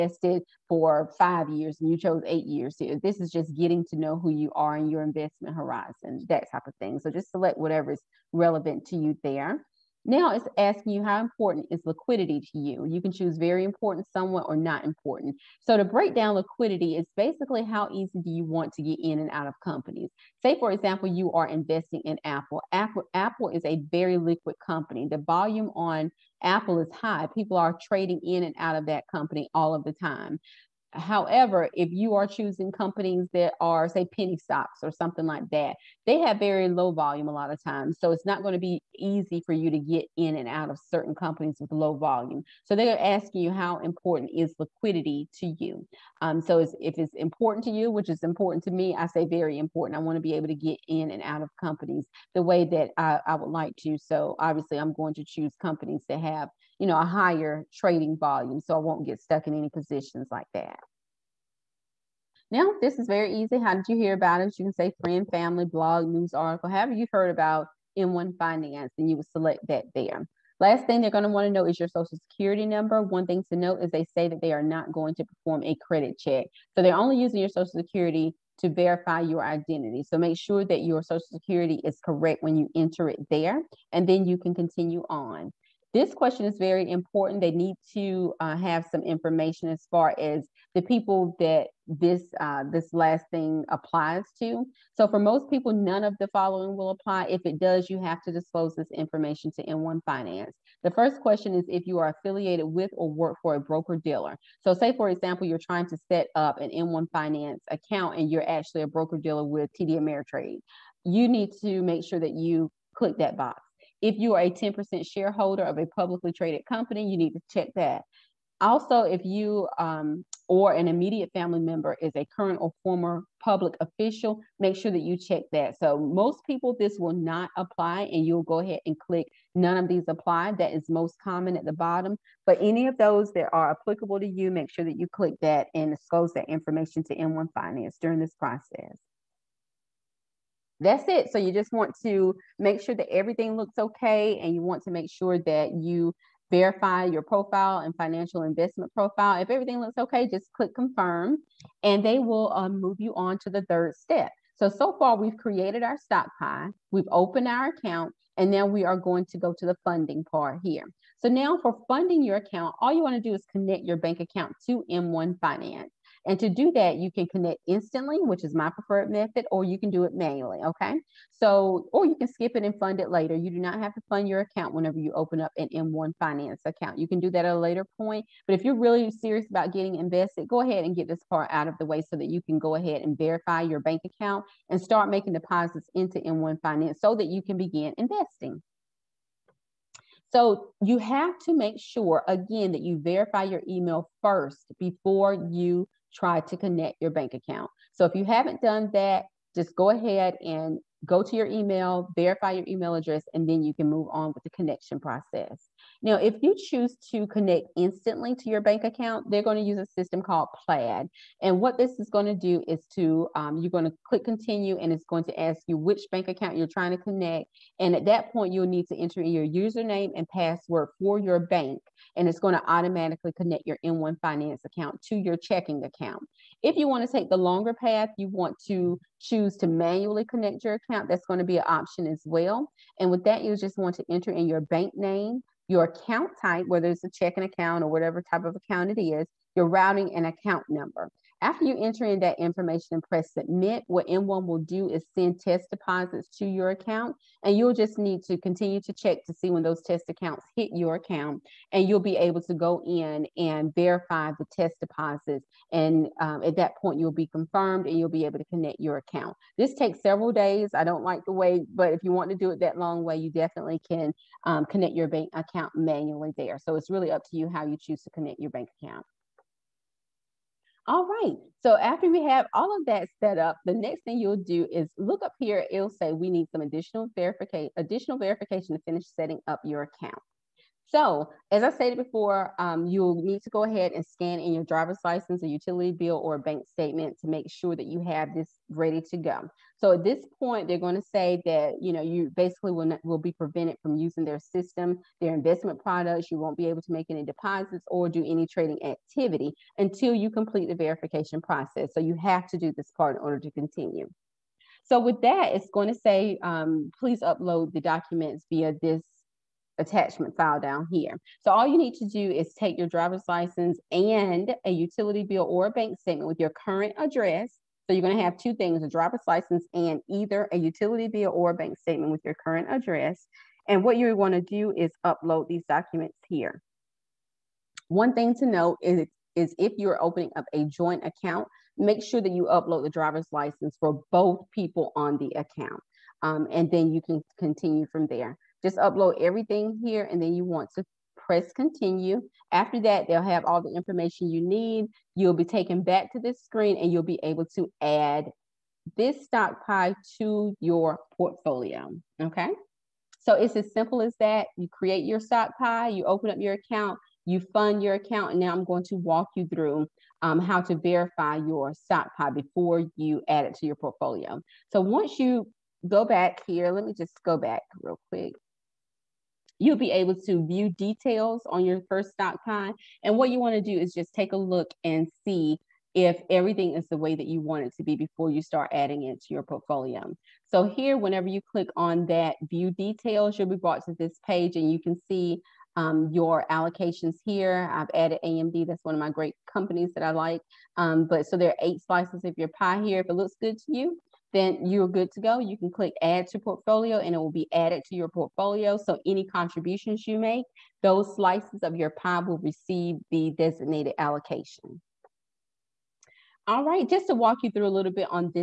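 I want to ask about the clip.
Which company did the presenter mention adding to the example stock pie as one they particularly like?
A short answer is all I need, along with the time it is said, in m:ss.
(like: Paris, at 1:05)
AMD, at 6:28.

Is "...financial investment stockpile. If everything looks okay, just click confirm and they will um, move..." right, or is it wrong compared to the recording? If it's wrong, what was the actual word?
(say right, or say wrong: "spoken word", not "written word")
wrong: "profile", not "stockpile".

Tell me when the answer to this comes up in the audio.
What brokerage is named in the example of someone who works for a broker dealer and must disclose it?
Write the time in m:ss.
1:49.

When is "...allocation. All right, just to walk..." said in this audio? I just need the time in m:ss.
6:43.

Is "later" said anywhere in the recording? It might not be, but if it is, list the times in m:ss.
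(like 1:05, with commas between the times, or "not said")
2:53, 2:57.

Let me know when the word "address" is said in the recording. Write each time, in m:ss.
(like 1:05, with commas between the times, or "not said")
3:22, 5:16, 5:22.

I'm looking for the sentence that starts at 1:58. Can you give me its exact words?
Also, if you um, or an immediate family member is a current or former public official, make sure that you check that.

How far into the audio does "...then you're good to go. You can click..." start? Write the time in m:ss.
6:34.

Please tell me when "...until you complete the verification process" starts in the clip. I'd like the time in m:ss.
4:59.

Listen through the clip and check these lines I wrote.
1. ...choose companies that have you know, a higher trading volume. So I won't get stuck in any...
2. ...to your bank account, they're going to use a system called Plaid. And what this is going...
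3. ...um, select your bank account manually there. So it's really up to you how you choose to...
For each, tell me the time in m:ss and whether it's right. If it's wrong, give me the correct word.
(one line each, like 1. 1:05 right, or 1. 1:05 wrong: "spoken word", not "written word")
1. 0:55 right
2. 3:28 right
3. 4:24 wrong: "connect", not "select".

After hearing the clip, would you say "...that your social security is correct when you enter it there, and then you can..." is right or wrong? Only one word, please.
right.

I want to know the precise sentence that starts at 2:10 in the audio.
That is most common at the bottom.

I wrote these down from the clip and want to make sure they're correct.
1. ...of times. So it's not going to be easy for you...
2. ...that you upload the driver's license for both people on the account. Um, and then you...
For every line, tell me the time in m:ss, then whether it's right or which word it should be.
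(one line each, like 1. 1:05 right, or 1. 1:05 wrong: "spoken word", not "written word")
1. 0:37 right
2. 5:32 right.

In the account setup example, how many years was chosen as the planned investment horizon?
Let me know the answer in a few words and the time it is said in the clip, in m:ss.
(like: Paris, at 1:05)
8 years, at 0:02.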